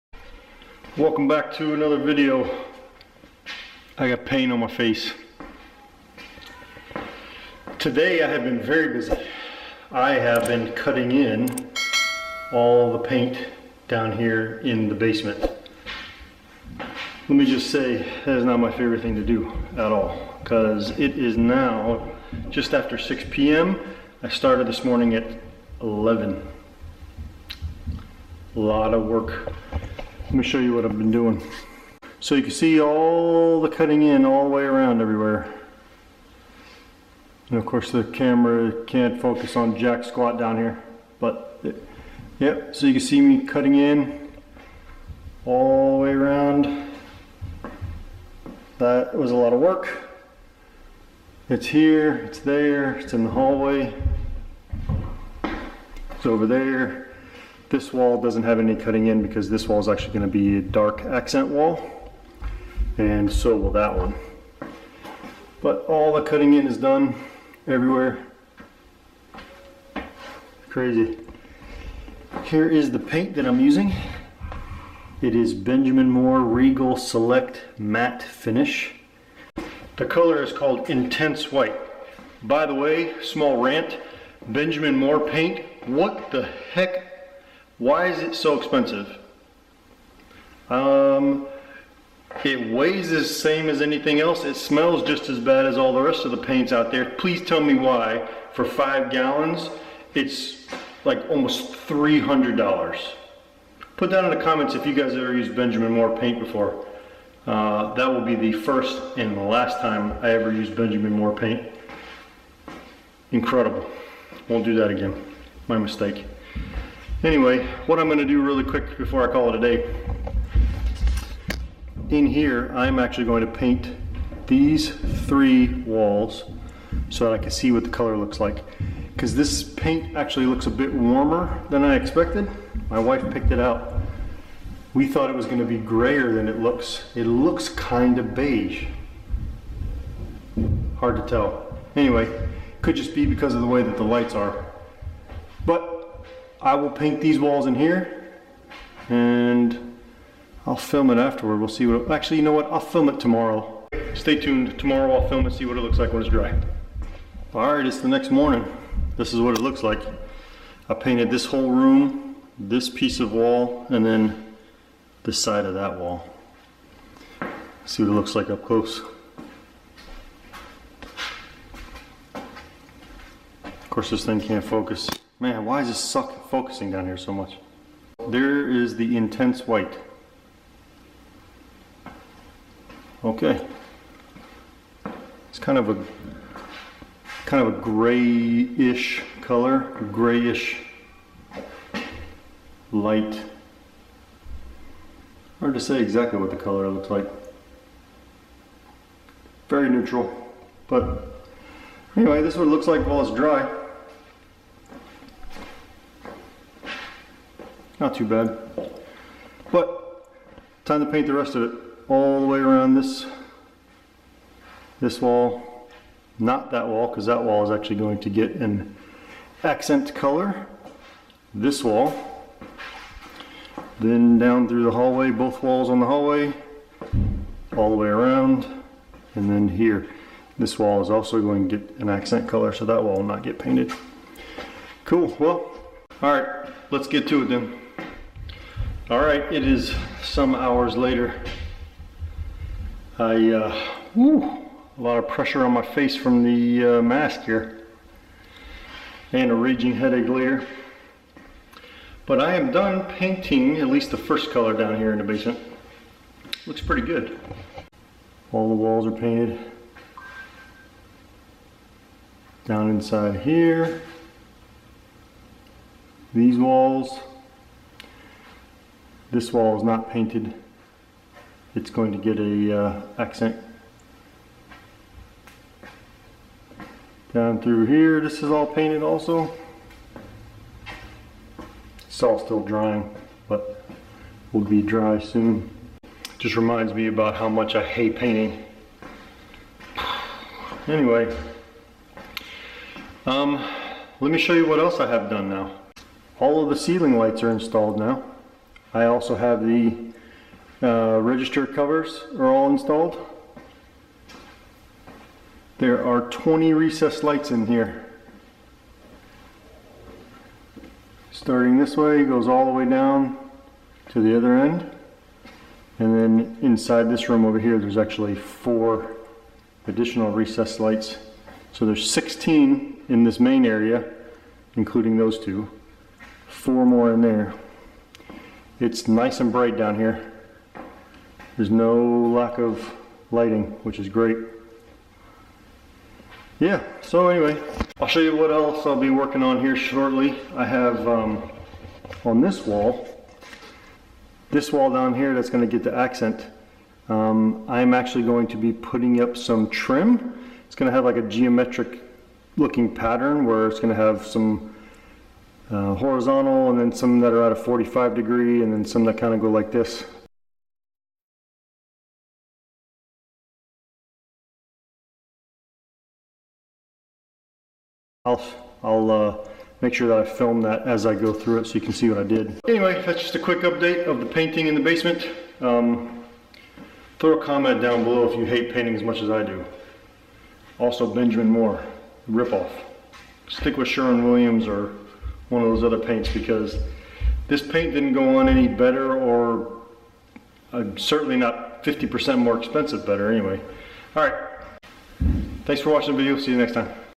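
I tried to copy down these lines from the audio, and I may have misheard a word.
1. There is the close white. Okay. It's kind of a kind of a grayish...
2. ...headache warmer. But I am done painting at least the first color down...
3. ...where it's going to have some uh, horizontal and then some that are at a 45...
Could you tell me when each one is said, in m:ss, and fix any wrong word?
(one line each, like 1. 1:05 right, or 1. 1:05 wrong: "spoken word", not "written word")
1. 2:58 wrong: "intense", not "close"
2. 4:09 wrong: "later", not "warmer"
3. 5:53 right.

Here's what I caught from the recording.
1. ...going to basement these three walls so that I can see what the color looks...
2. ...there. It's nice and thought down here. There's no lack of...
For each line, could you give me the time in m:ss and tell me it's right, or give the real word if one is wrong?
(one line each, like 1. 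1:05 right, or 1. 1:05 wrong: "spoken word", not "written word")
1. 2:03 wrong: "paint", not "basement"
2. 5:27 wrong: "bright", not "thought".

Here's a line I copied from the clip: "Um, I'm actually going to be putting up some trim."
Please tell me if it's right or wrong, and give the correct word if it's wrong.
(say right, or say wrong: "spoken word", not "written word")
right.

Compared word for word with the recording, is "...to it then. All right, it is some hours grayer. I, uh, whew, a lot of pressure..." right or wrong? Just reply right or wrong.
wrong.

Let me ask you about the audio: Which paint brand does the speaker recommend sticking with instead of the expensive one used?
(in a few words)
Sherwin Williams.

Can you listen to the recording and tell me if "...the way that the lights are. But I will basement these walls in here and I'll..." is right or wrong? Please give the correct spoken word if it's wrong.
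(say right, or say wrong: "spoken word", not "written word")
wrong: "paint", not "basement".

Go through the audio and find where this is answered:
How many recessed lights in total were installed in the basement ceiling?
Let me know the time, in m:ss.
5:06.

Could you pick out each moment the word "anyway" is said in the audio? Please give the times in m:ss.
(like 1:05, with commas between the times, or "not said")
1:57, 2:21, 3:22, 4:50, 5:37, 6:12, 6:33.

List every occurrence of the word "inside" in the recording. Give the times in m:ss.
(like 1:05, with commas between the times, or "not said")
4:22, 5:16.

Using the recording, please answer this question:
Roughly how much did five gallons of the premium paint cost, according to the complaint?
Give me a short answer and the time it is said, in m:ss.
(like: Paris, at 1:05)
$300, at 1:41.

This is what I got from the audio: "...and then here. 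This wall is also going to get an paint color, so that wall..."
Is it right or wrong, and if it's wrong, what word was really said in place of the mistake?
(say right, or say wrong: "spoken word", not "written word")
wrong: "accent", not "paint".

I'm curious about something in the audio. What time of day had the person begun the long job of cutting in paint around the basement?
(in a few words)
11.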